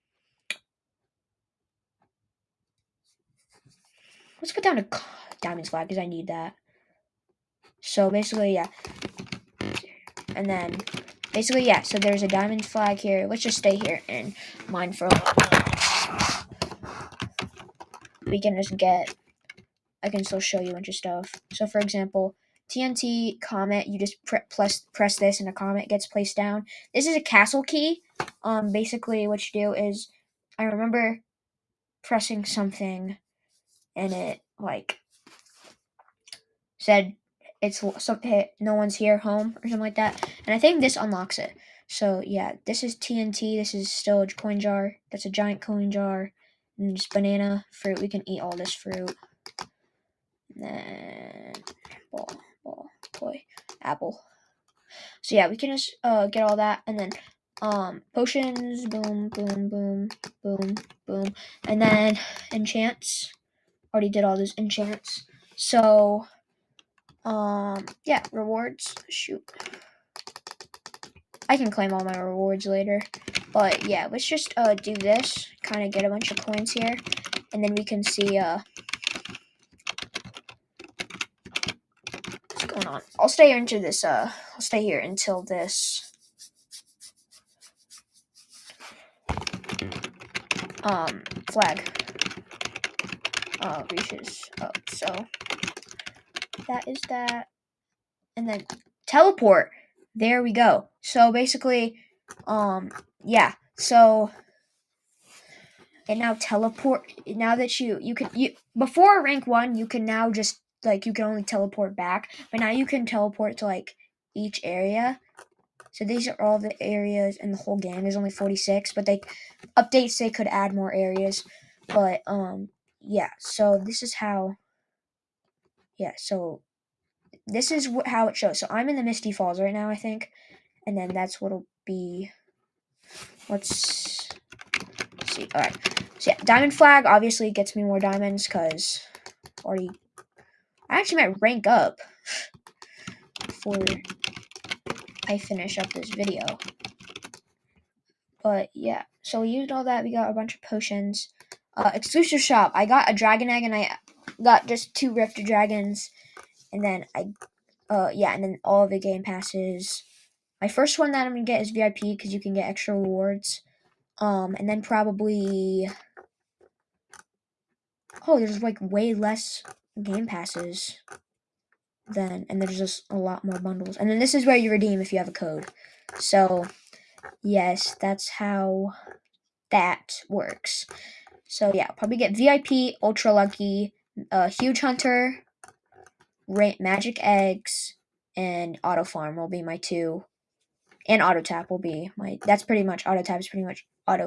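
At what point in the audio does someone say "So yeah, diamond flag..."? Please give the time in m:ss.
2:16.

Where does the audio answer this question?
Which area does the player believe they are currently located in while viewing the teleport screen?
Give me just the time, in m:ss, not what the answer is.
2:09.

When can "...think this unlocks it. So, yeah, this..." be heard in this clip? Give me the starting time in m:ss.
0:40.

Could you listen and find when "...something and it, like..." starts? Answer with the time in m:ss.
0:32.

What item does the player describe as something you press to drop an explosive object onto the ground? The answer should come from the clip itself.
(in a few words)
TNT comet.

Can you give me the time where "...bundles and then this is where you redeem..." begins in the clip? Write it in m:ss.
2:53.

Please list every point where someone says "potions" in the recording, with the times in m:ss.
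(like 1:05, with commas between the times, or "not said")
0:58, 2:30.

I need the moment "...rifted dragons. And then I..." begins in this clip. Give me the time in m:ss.
2:35.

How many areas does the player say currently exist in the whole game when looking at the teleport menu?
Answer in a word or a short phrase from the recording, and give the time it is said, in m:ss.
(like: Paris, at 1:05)
46, at 1:58.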